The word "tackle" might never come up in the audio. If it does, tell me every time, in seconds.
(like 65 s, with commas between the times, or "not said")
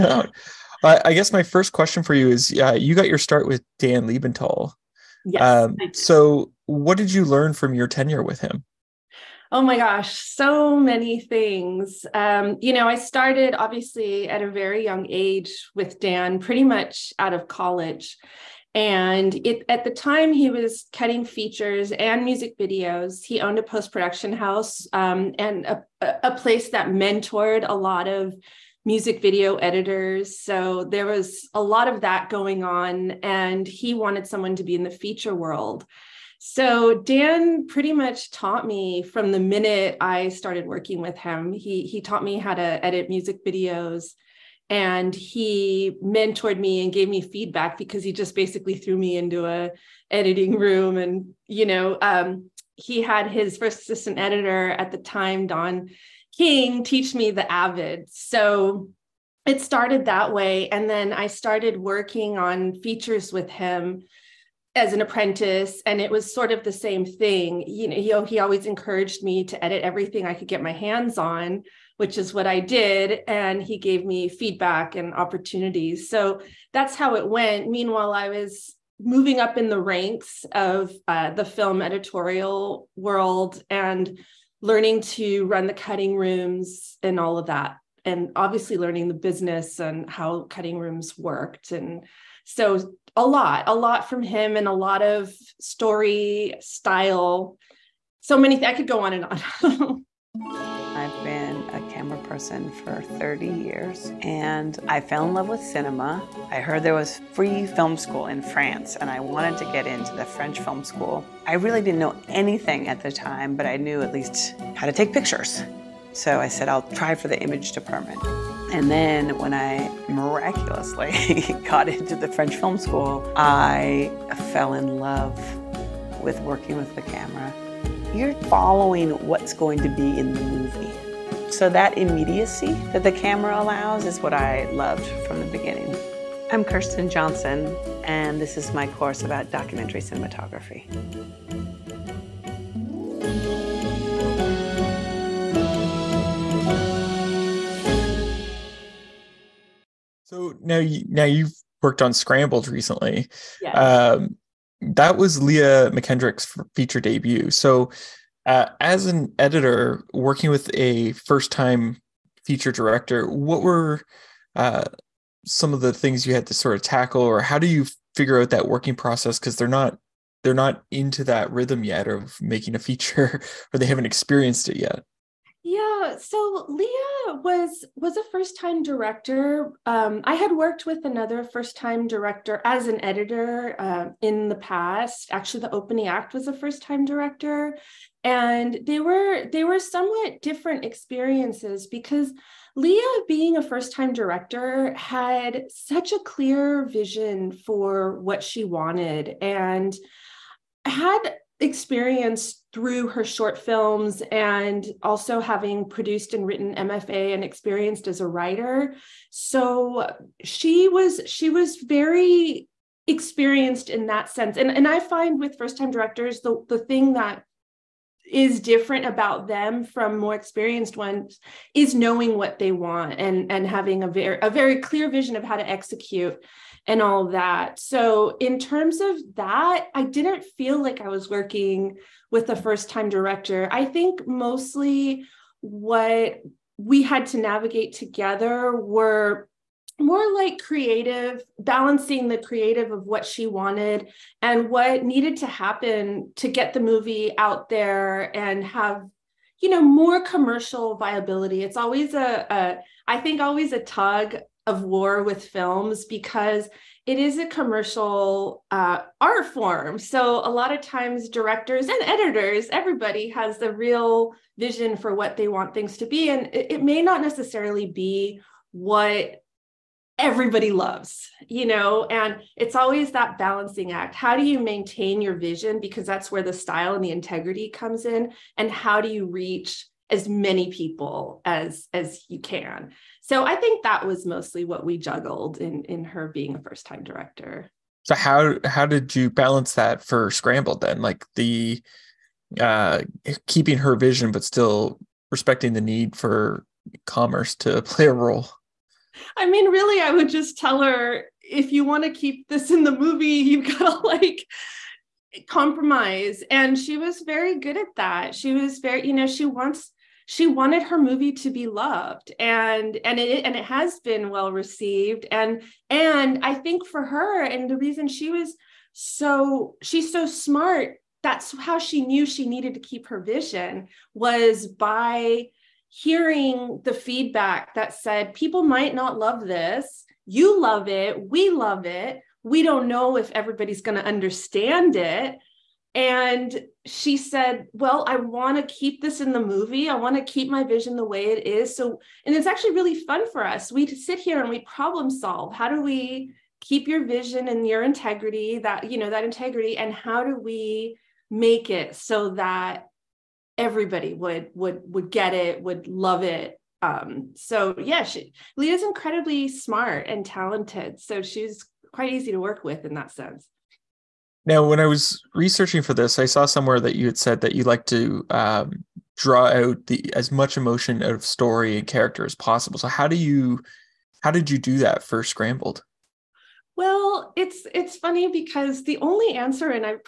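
166 s.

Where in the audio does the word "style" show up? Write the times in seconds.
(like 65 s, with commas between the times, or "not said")
96 s, 276 s.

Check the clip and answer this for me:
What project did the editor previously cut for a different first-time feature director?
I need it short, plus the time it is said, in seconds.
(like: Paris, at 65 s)
The Opening Act, at 185 s.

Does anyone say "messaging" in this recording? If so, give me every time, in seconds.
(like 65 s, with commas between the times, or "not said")
not said.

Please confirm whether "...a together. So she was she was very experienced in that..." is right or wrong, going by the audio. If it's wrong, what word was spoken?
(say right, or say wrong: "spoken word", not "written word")
wrong: "writer", not "together".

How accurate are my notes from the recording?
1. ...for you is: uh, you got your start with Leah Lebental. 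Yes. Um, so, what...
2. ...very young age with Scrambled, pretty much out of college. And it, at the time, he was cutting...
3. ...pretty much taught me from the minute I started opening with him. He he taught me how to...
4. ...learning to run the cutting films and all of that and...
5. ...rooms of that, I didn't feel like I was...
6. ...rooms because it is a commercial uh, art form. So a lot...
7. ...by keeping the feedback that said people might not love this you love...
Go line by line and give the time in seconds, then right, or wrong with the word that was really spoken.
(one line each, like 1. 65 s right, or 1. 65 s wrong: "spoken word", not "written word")
1. 2 s wrong: "Dan", not "Leah"
2. 14 s wrong: "Dan", not "Scrambled"
3. 37 s wrong: "working", not "opening"
4. 84 s wrong: "rooms", not "films"
5. 228 s wrong: "terms", not "rooms"
6. 255 s wrong: "films", not "rooms"
7. 324 s wrong: "hearing", not "keeping".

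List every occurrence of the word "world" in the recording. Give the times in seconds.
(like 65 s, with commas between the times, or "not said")
35 s, 82 s.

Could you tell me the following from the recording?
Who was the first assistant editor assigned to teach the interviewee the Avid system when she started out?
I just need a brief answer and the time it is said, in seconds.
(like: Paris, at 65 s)
Don King, at 55 s.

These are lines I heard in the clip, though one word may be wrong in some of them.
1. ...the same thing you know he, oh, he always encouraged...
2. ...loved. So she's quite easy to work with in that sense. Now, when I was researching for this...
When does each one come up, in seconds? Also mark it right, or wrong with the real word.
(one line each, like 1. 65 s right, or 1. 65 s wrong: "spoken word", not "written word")
1. 66 s right
2. 360 s wrong: "talented", not "loved".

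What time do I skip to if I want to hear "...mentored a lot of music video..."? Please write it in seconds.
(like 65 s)
26 s.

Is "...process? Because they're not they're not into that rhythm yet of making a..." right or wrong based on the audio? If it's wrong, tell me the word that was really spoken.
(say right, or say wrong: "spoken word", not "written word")
right.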